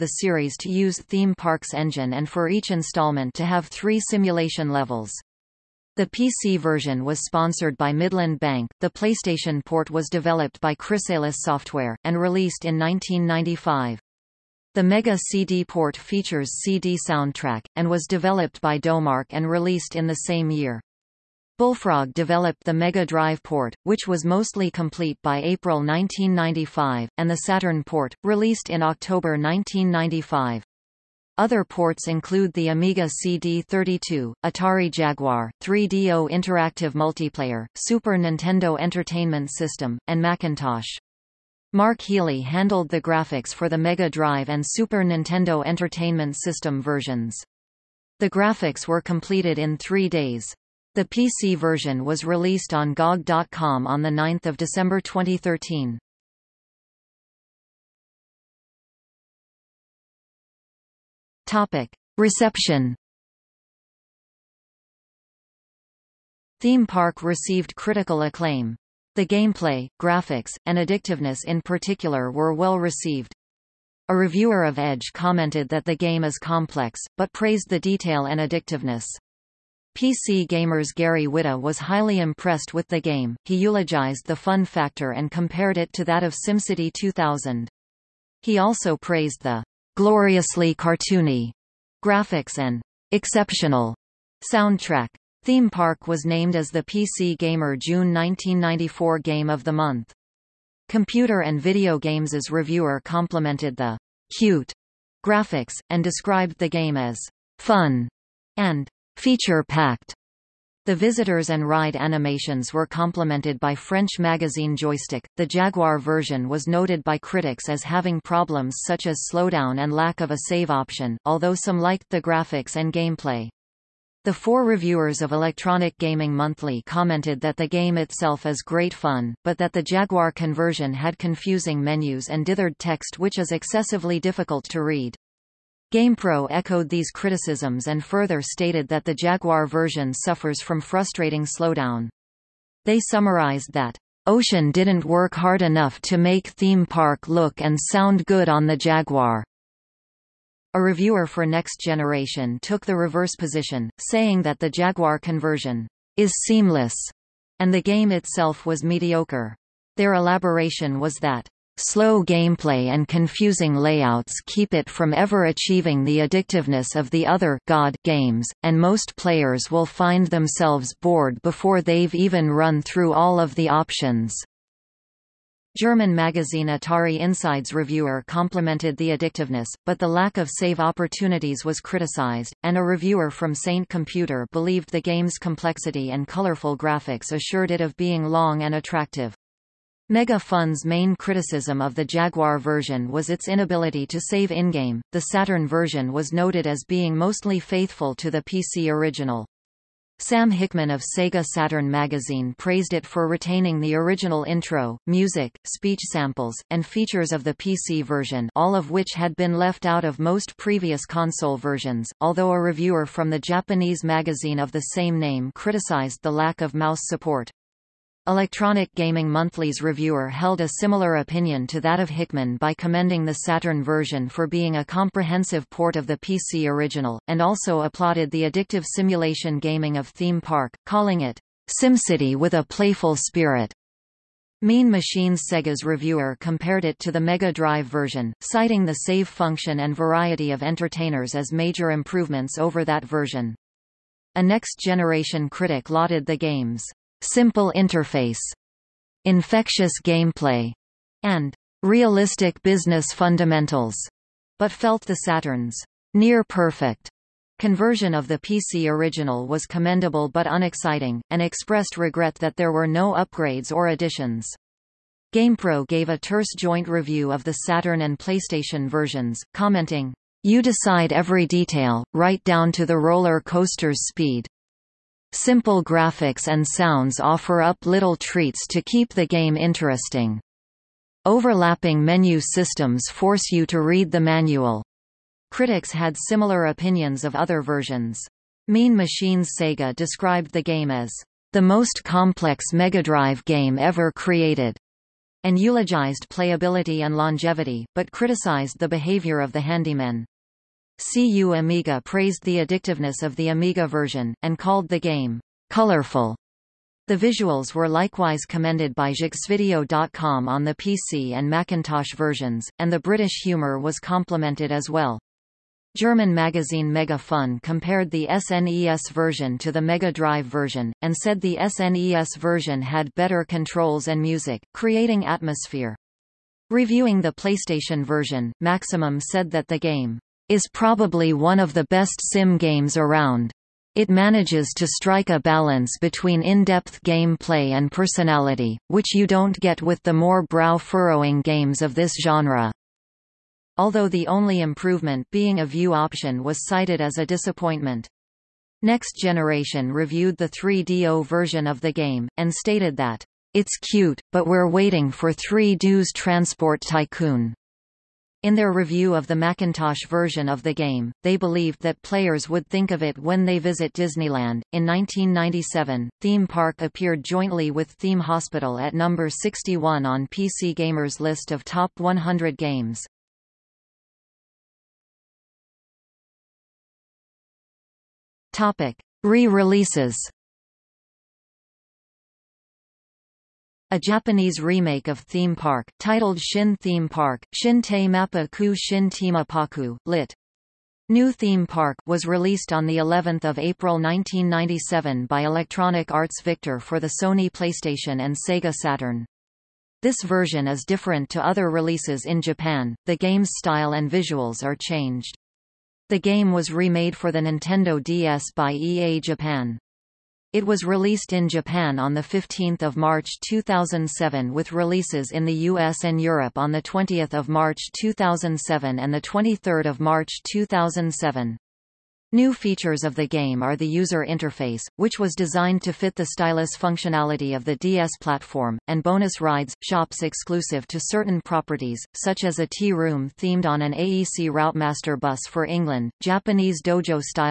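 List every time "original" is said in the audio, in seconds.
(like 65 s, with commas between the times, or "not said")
198 s, 203 s, 226 s, 258 s.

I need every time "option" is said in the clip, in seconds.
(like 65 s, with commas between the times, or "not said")
120 s, 173 s, 345 s.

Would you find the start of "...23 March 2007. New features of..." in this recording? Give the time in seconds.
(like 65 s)
419 s.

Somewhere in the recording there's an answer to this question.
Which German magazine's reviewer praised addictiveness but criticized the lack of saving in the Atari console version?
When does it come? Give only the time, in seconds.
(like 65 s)
176 s.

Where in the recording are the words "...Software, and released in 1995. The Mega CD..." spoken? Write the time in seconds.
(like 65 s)
11 s.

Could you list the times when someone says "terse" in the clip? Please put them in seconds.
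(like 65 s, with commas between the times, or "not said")
266 s.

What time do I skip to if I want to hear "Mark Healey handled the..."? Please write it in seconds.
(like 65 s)
41 s.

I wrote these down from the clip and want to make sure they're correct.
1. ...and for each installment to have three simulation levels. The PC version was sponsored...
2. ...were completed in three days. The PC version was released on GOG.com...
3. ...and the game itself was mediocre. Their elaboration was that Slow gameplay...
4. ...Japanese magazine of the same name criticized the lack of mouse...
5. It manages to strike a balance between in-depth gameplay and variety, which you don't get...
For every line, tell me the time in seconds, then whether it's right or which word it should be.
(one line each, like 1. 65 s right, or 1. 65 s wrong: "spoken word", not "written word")
1. 2 s right
2. 48 s right
3. 157 s right
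4. 213 s right
5. 333 s wrong: "personality", not "variety".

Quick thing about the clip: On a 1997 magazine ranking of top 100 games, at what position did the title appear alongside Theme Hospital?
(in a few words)
61.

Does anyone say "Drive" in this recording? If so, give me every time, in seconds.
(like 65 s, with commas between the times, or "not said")
23 s, 44 s, 237 s, 293 s, 320 s.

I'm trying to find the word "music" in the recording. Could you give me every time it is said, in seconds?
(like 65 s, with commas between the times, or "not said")
205 s, 324 s.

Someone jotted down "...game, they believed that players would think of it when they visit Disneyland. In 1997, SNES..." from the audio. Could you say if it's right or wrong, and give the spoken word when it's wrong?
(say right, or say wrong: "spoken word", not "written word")
wrong: "Theme", not "SNES".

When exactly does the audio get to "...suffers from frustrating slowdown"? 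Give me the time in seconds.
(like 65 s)
140 s.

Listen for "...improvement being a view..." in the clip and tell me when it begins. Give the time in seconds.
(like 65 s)
344 s.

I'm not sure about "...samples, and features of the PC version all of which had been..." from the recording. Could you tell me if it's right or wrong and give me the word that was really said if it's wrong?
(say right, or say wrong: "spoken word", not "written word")
right.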